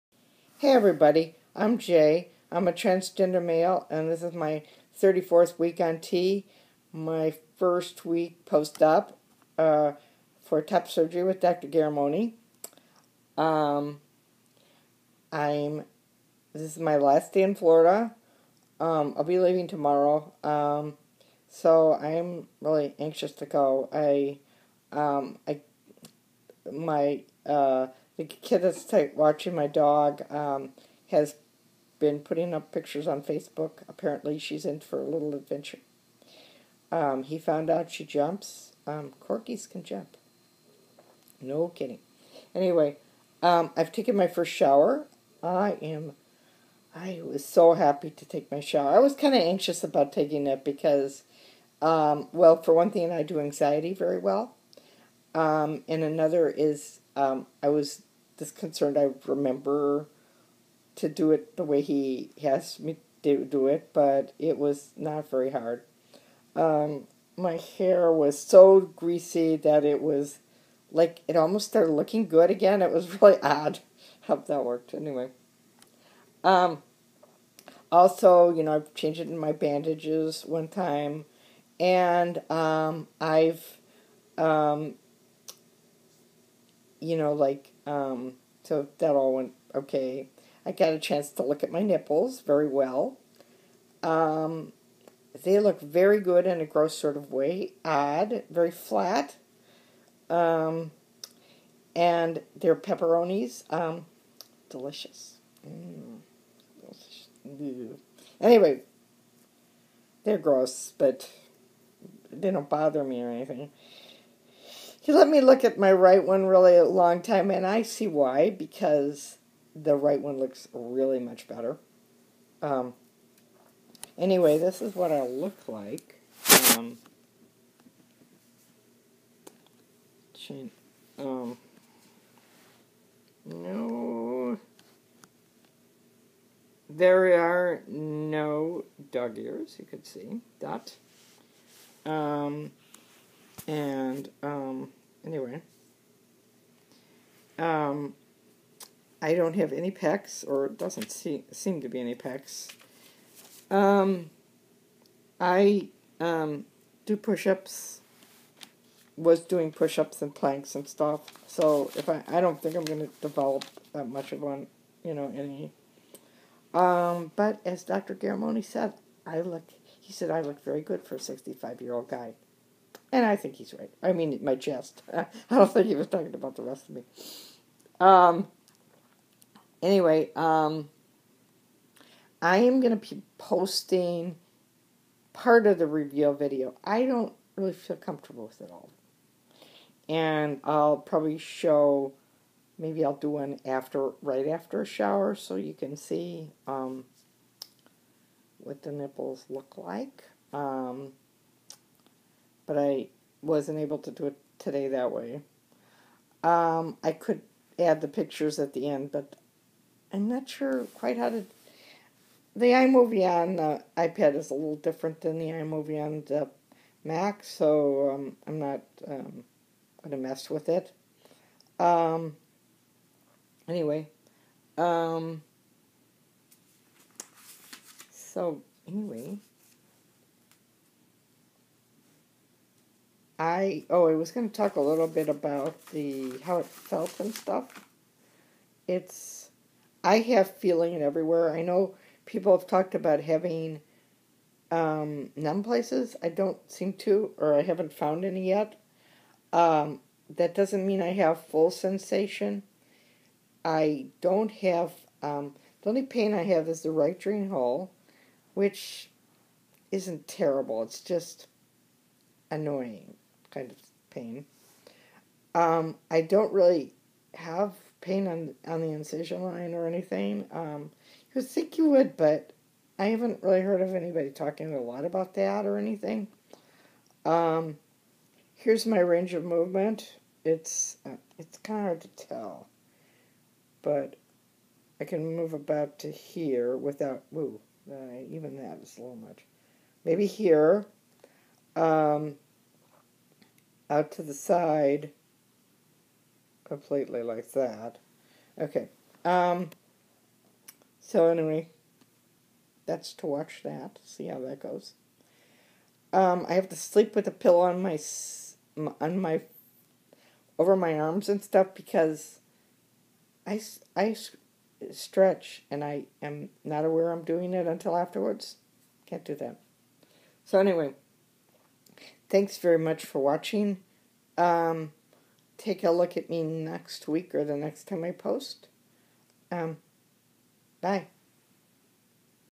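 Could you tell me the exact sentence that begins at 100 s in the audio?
Um, and their pepperonis, um, delicious.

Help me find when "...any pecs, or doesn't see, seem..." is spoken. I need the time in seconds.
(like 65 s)
149 s.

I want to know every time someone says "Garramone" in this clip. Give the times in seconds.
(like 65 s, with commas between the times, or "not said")
11 s, 168 s.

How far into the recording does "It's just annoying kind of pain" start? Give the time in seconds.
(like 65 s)
260 s.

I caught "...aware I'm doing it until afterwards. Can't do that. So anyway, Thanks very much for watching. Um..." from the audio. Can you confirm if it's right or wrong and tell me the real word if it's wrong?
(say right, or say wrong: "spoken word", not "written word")
right.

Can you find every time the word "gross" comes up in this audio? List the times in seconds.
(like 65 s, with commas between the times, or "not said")
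96 s, 110 s.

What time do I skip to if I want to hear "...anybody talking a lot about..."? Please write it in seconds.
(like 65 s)
273 s.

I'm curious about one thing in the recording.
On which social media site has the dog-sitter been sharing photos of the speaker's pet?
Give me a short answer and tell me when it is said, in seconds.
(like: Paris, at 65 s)
Facebook, at 33 s.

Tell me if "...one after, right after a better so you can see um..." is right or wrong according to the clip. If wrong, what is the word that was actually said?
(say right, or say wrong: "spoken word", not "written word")
wrong: "shower", not "better".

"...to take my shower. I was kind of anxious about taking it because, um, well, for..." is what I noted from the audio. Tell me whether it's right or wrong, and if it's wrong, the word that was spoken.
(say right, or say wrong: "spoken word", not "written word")
right.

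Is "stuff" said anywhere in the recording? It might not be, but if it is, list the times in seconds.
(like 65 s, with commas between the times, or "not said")
160 s, 237 s, 311 s.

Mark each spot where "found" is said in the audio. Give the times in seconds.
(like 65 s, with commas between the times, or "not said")
37 s, 247 s.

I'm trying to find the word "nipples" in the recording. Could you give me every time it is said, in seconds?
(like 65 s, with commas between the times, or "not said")
91 s, 198 s.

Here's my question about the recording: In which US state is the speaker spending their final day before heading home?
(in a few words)
Florida.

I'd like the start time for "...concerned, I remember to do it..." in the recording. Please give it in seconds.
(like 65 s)
58 s.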